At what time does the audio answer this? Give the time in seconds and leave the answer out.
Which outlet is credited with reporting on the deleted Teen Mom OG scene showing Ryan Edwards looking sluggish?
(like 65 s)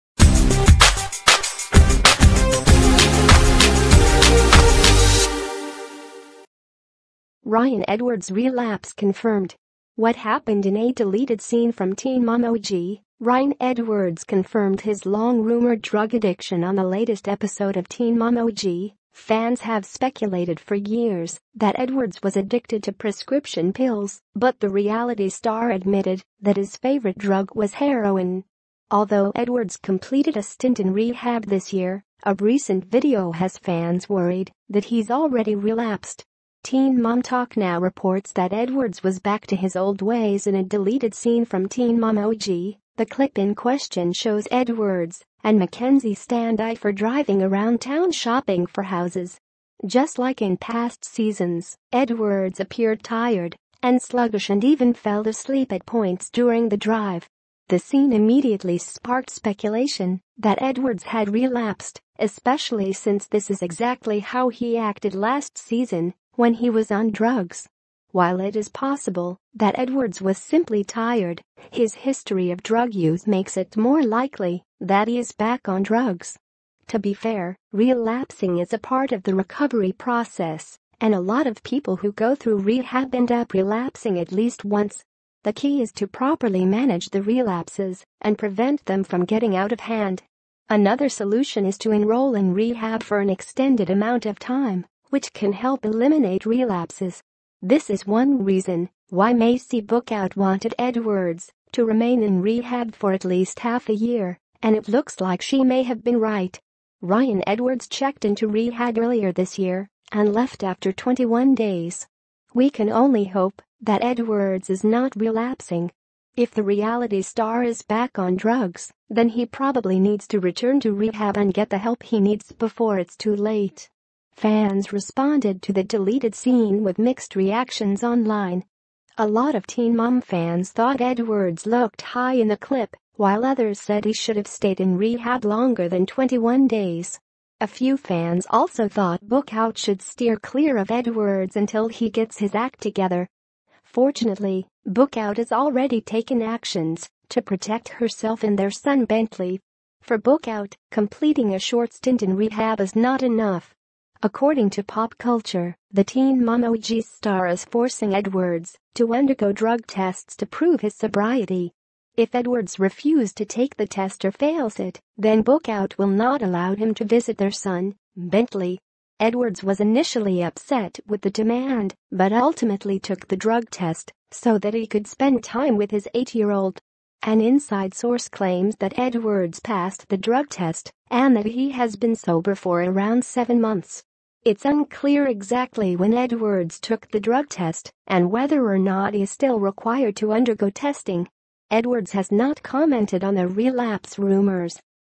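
36 s.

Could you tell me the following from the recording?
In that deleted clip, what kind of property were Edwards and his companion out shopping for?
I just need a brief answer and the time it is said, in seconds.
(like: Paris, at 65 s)
Houses, at 48 s.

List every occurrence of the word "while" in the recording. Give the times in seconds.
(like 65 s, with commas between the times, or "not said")
68 s, 133 s.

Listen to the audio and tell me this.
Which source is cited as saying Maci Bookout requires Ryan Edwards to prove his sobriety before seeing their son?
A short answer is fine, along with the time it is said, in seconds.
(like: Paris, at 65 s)
Pop culture, at 154 s.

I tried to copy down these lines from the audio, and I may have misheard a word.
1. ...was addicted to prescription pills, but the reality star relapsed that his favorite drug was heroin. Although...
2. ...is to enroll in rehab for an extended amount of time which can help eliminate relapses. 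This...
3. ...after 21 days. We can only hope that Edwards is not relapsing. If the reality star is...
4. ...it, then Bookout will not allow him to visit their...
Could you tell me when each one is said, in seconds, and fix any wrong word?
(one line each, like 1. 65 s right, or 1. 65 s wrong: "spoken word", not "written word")
1. 22 s wrong: "admitted", not "relapsed"
2. 91 s right
3. 110 s right
4. 164 s right.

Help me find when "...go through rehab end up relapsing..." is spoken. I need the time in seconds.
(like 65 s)
82 s.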